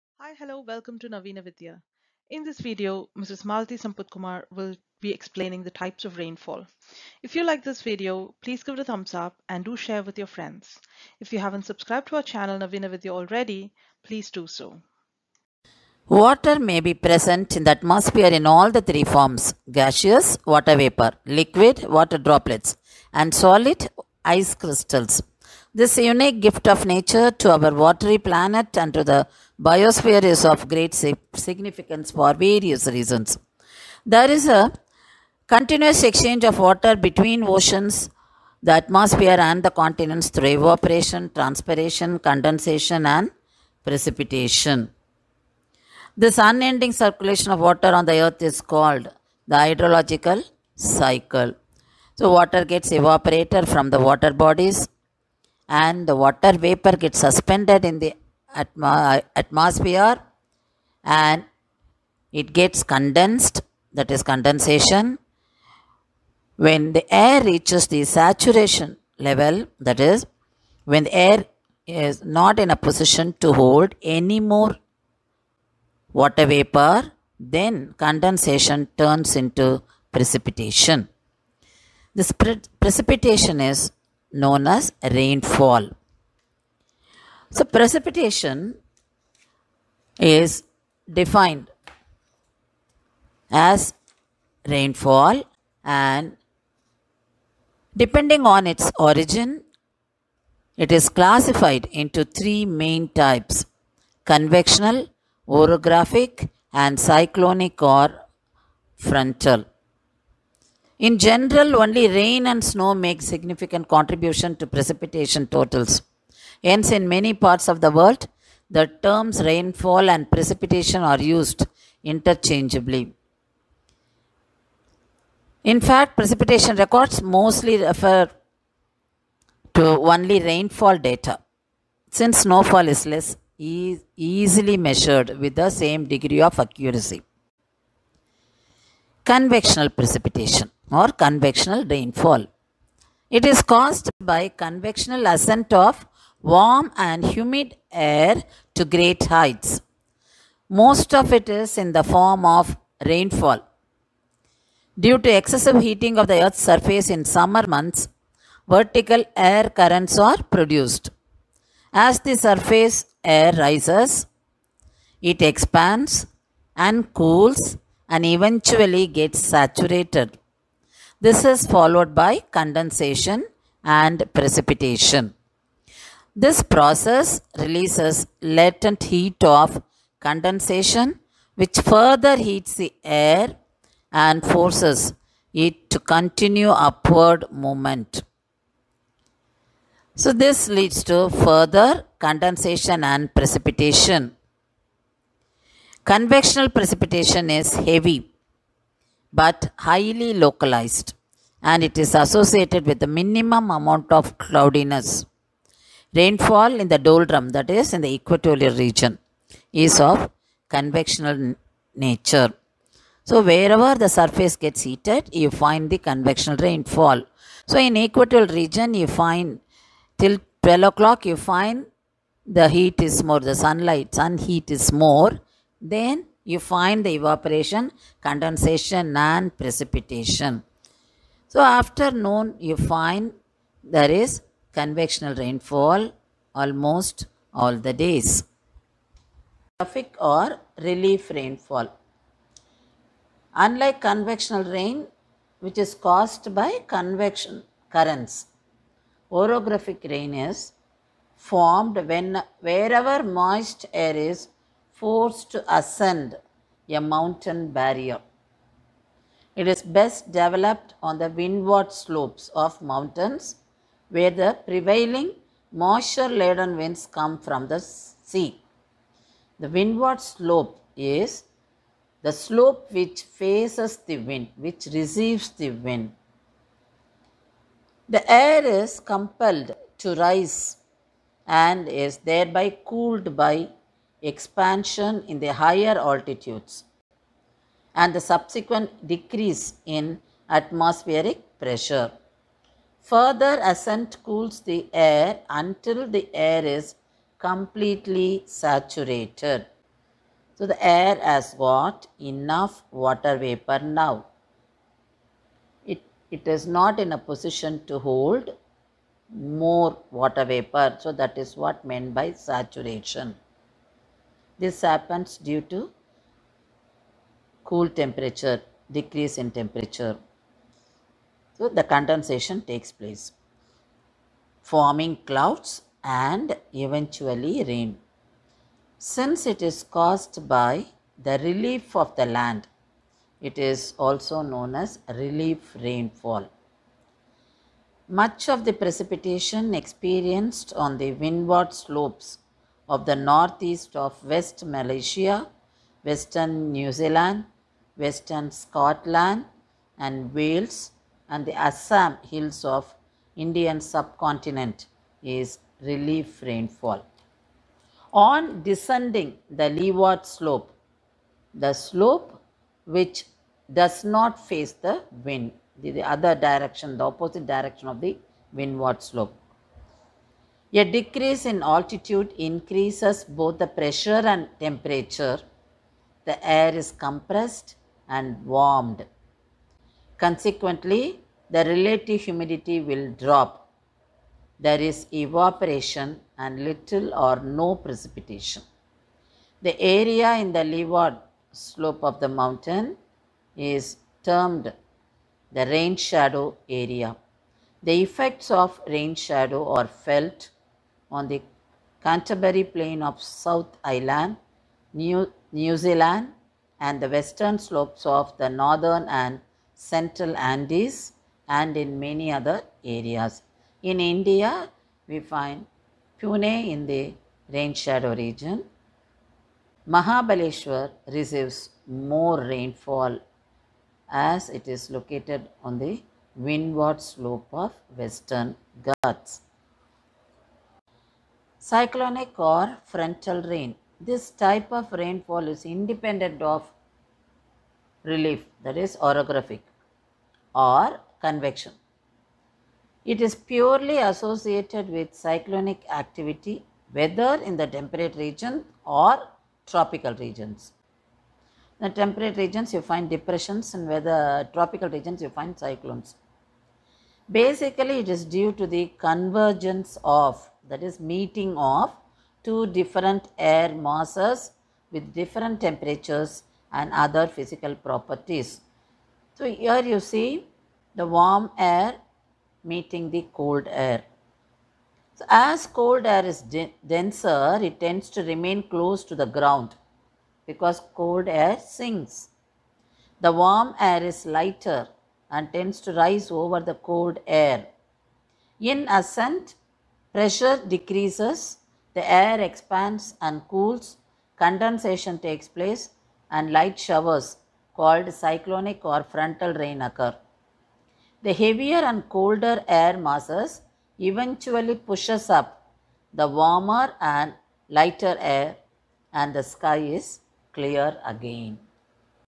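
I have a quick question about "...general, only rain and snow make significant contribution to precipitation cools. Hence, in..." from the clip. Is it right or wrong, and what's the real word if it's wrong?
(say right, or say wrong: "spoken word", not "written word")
wrong: "totals", not "cools".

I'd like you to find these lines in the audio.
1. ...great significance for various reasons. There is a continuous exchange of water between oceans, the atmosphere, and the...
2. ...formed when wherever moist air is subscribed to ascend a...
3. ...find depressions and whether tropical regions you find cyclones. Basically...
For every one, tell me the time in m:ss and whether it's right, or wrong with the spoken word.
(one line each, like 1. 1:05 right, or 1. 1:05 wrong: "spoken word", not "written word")
1. 0:30 right
2. 4:11 wrong: "forced", not "subscribed"
3. 7:32 right.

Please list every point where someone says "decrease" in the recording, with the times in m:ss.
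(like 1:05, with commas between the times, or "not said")
4:49, 5:18, 6:10, 8:10.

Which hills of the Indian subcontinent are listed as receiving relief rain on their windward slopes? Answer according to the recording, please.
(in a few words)
Assam hills.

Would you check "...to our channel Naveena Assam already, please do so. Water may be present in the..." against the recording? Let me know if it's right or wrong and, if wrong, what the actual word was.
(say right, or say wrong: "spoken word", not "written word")
wrong: "Vidhya", not "Assam".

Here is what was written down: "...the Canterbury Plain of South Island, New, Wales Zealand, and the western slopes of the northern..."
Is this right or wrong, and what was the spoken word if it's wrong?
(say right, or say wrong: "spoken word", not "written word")
wrong: "New", not "Wales".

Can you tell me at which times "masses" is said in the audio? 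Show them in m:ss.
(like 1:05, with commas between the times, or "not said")
7:43, 8:22.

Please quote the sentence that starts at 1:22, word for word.
This pre- precipitation is known as rainfall.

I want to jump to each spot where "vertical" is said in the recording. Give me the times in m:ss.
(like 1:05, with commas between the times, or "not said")
2:38.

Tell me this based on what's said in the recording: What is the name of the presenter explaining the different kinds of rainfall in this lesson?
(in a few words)
Mrs. Malathi Kumar.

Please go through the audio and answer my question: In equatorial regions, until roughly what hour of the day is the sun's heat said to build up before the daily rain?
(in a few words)
12 o'clock.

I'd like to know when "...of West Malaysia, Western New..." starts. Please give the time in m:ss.
5:43.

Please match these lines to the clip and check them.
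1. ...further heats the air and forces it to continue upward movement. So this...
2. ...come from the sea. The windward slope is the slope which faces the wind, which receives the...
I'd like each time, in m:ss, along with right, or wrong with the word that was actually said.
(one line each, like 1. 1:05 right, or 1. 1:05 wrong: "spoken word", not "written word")
1. 3:01 right
2. 4:27 right.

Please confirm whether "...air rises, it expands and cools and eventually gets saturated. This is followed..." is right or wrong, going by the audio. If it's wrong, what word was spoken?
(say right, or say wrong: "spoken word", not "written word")
right.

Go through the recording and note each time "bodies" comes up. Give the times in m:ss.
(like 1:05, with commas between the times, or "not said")
0:54.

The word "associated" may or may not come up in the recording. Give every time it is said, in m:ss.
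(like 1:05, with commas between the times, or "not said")
3:22, 7:23.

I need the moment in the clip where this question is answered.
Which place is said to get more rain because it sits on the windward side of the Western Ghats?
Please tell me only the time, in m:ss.
6:59.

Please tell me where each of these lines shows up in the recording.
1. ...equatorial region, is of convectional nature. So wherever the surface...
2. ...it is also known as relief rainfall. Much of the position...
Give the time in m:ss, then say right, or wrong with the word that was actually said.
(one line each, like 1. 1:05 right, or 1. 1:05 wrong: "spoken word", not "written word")
1. 3:28 right
2. 5:33 wrong: "precipitation", not "position".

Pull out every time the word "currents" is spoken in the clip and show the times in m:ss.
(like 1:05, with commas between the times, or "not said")
2:39, 4:07.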